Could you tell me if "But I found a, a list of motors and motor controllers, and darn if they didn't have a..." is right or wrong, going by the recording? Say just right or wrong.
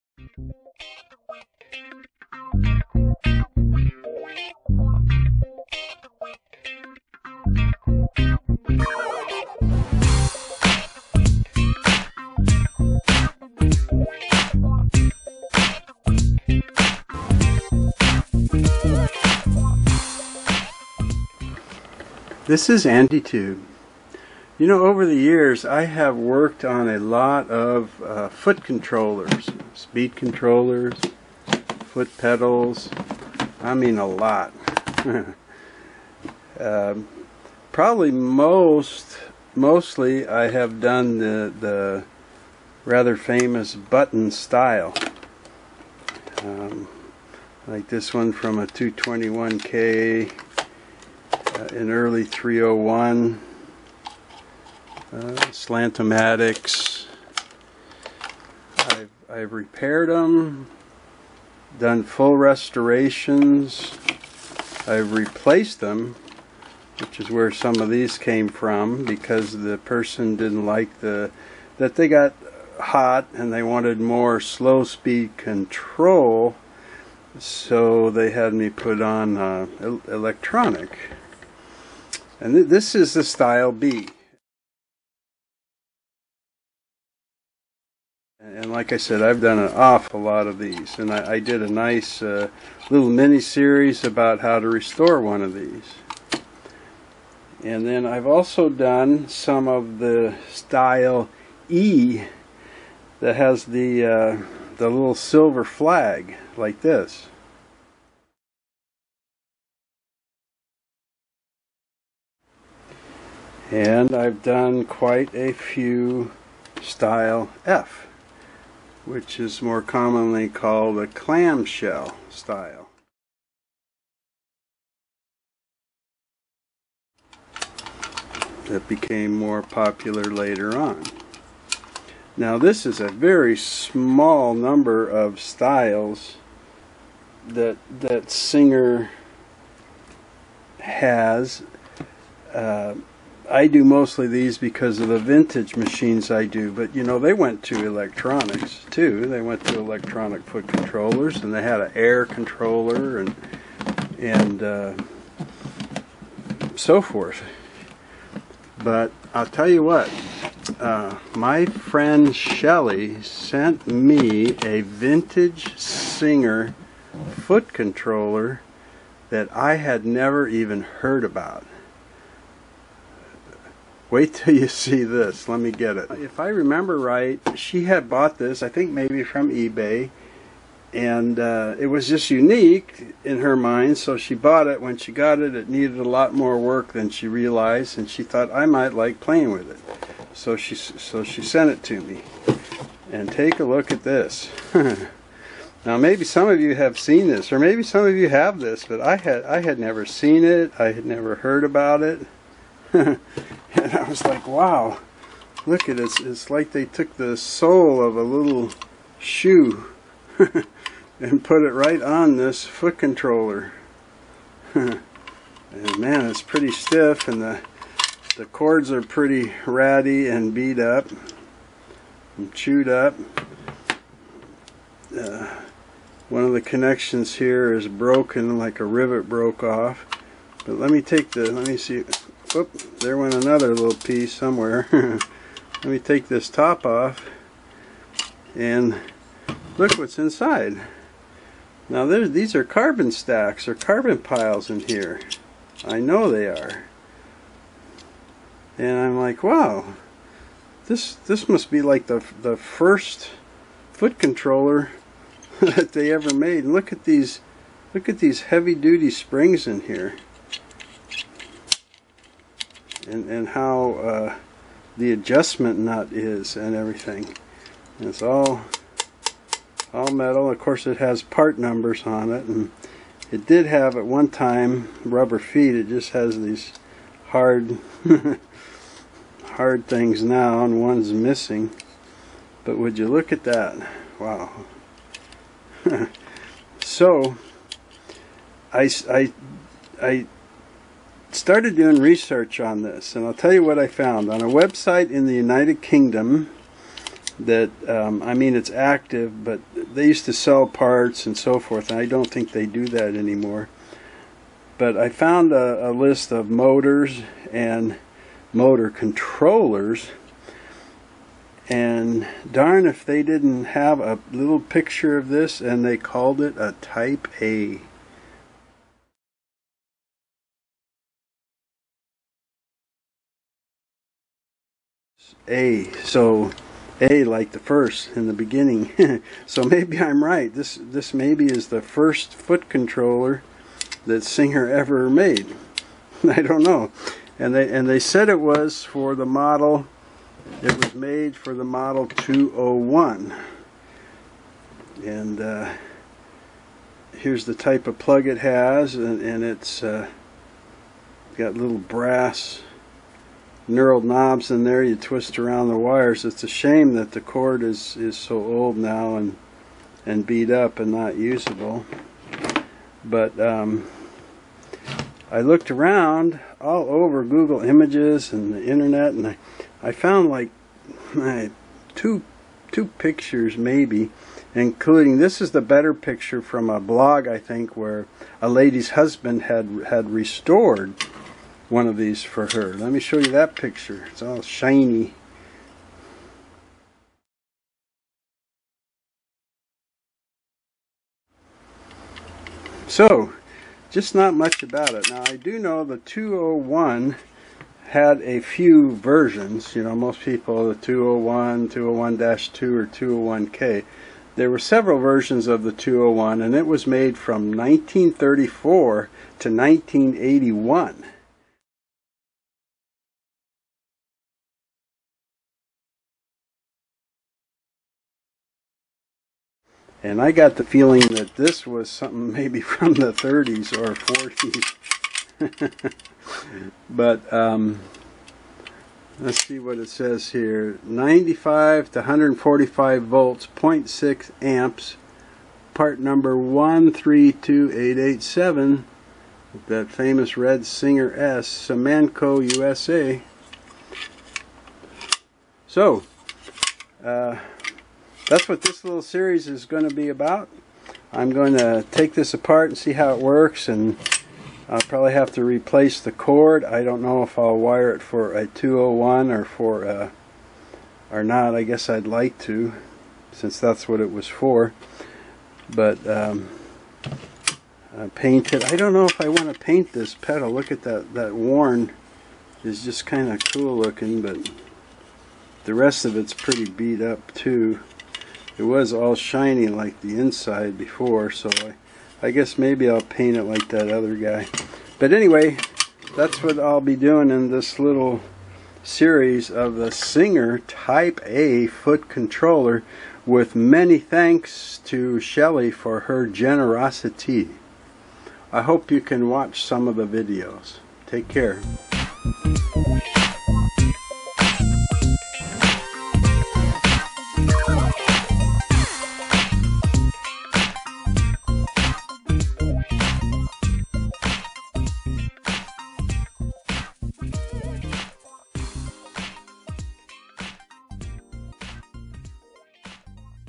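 right.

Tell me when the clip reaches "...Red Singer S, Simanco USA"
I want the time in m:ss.
7:20.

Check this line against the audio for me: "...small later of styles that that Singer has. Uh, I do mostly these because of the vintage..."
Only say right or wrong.
wrong.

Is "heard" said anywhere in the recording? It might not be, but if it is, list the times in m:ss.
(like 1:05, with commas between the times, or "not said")
2:50, 3:21.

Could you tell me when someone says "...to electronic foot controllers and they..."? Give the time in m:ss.
2:29.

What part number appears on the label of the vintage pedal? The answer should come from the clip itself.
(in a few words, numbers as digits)
132887.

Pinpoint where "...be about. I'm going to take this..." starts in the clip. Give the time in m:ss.
7:29.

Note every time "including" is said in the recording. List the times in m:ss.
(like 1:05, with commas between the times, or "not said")
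6:14.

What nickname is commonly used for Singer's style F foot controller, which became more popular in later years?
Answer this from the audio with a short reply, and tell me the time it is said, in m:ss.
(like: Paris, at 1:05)
Clamshell, at 2:01.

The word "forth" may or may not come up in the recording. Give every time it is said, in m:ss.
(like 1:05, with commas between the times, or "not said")
2:37, 5:01.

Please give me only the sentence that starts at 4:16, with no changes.
And look at these look at these heavy duty springs in here and, and how uh, the adjustment nut is and everything.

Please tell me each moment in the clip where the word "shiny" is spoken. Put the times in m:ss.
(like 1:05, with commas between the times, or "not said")
6:24, 7:59.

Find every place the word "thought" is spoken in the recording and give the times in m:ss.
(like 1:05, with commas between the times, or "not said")
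3:08.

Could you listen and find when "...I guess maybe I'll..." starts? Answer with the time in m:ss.
8:02.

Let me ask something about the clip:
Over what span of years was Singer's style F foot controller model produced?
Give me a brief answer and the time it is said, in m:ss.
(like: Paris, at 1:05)
1934 to 1981, at 6:47.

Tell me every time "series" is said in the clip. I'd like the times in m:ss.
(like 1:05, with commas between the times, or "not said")
1:33, 7:29, 8:08.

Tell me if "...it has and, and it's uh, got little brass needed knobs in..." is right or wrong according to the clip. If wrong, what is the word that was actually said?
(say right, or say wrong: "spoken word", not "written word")
wrong: "knurled", not "needed".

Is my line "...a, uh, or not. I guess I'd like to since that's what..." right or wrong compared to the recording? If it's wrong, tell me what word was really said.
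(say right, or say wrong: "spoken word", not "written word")
right.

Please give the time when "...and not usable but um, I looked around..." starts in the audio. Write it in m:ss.
6:00.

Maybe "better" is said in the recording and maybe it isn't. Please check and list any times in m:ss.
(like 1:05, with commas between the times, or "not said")
6:15.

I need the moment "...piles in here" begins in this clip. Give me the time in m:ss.
4:04.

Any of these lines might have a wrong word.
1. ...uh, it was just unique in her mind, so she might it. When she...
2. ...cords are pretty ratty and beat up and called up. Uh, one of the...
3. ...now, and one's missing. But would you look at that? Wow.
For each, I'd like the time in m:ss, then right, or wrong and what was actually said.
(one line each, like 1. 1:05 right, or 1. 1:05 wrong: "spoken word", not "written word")
1. 3:01 wrong: "bought", not "might"
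2. 3:38 wrong: "chewed", not "called"
3. 4:40 right.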